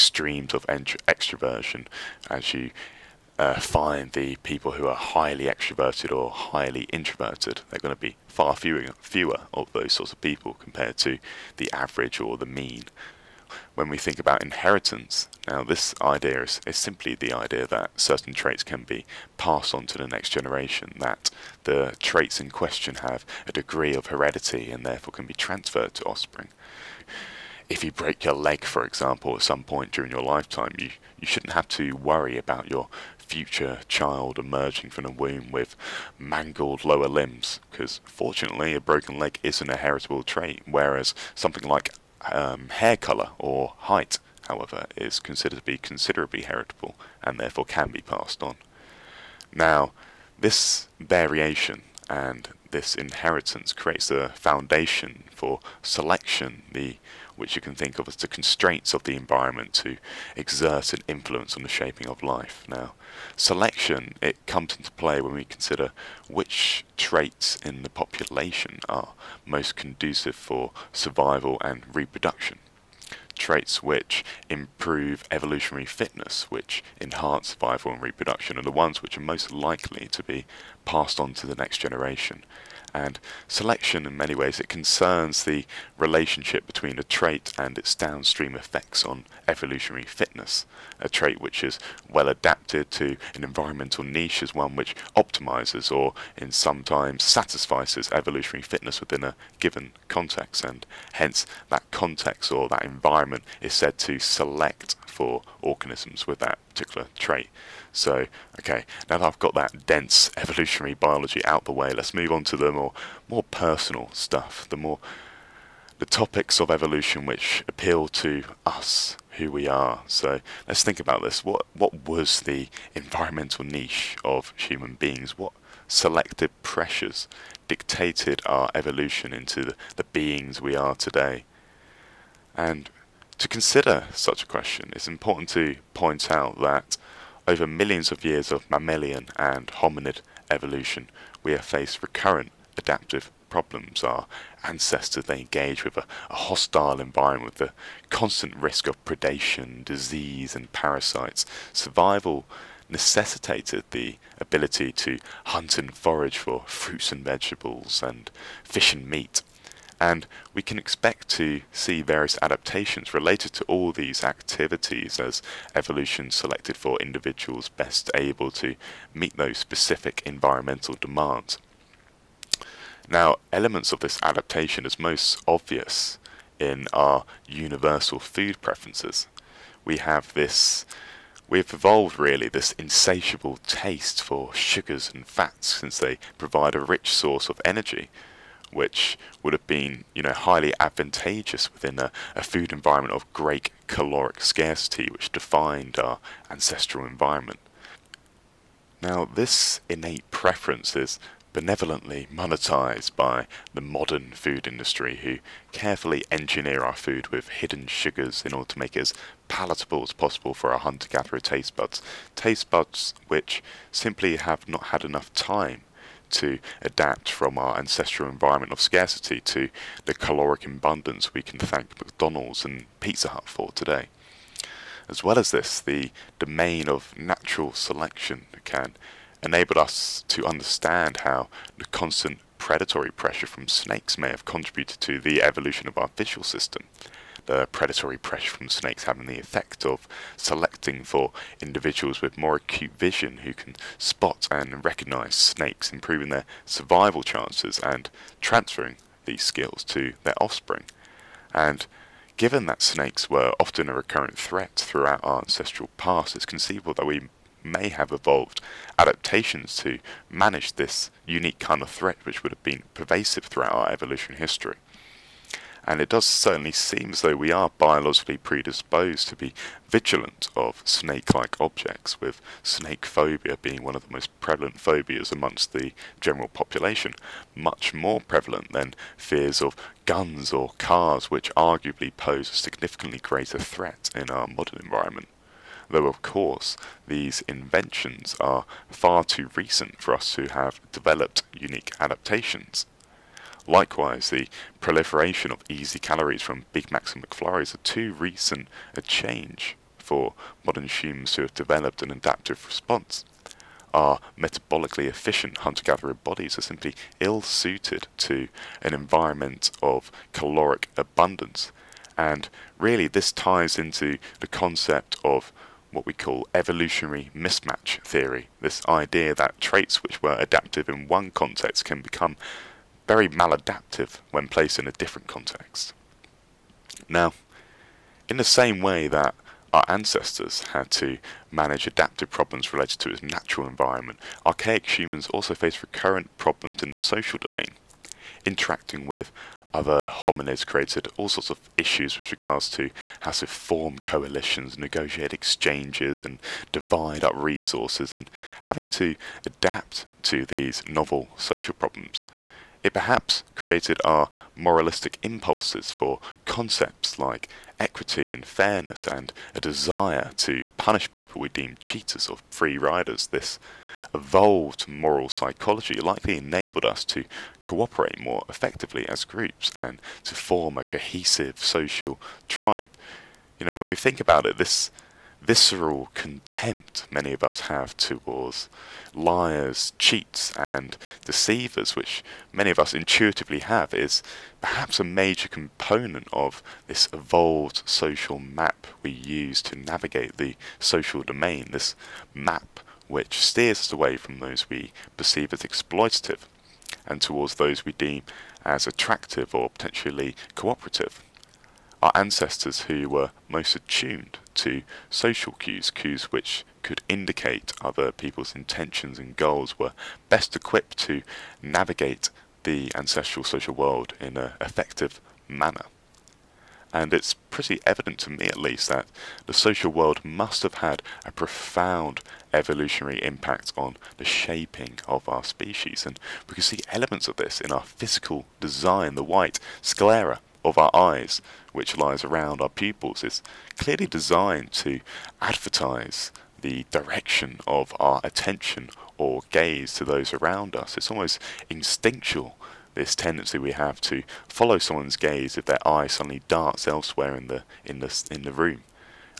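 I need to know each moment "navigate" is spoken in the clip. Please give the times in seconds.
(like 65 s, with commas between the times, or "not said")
389 s, 411 s.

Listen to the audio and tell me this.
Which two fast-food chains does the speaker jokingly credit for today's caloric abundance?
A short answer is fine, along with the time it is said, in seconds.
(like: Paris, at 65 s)
McDonald's and Pizza Hut, at 221 s.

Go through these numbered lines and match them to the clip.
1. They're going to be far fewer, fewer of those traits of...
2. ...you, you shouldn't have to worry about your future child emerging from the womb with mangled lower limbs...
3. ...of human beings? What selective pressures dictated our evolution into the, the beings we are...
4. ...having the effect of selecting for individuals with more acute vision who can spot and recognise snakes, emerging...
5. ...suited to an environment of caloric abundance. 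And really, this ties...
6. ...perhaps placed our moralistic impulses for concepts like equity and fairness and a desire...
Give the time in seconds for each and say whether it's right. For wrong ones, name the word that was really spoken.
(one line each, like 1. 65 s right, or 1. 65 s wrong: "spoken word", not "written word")
1. 7 s wrong: "sorts", not "traits"
2. 30 s right
3. 124 s right
4. 239 s wrong: "improving", not "emerging"
5. 307 s right
6. 352 s wrong: "created", not "placed".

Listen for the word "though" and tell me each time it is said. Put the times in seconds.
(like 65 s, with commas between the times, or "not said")
267 s, 285 s.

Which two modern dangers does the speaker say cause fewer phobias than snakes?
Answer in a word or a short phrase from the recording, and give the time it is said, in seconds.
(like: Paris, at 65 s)
guns or cars, at 280 s.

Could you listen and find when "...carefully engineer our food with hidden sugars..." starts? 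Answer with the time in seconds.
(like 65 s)
205 s.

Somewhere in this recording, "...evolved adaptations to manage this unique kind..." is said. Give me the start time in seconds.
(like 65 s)
258 s.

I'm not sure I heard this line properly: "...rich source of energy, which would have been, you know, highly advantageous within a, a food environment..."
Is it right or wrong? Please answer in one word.
right.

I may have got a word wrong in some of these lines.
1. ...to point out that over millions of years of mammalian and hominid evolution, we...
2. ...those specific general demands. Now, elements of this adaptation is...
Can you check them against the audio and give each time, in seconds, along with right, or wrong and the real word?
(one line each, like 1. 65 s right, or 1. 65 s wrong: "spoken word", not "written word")
1. 135 s right
2. 169 s wrong: "environmental", not "general".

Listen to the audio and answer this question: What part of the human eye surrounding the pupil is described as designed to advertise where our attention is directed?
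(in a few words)
white sclera.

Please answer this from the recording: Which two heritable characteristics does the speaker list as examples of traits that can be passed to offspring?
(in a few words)
hair colour or height.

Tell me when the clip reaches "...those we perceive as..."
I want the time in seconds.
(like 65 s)
394 s.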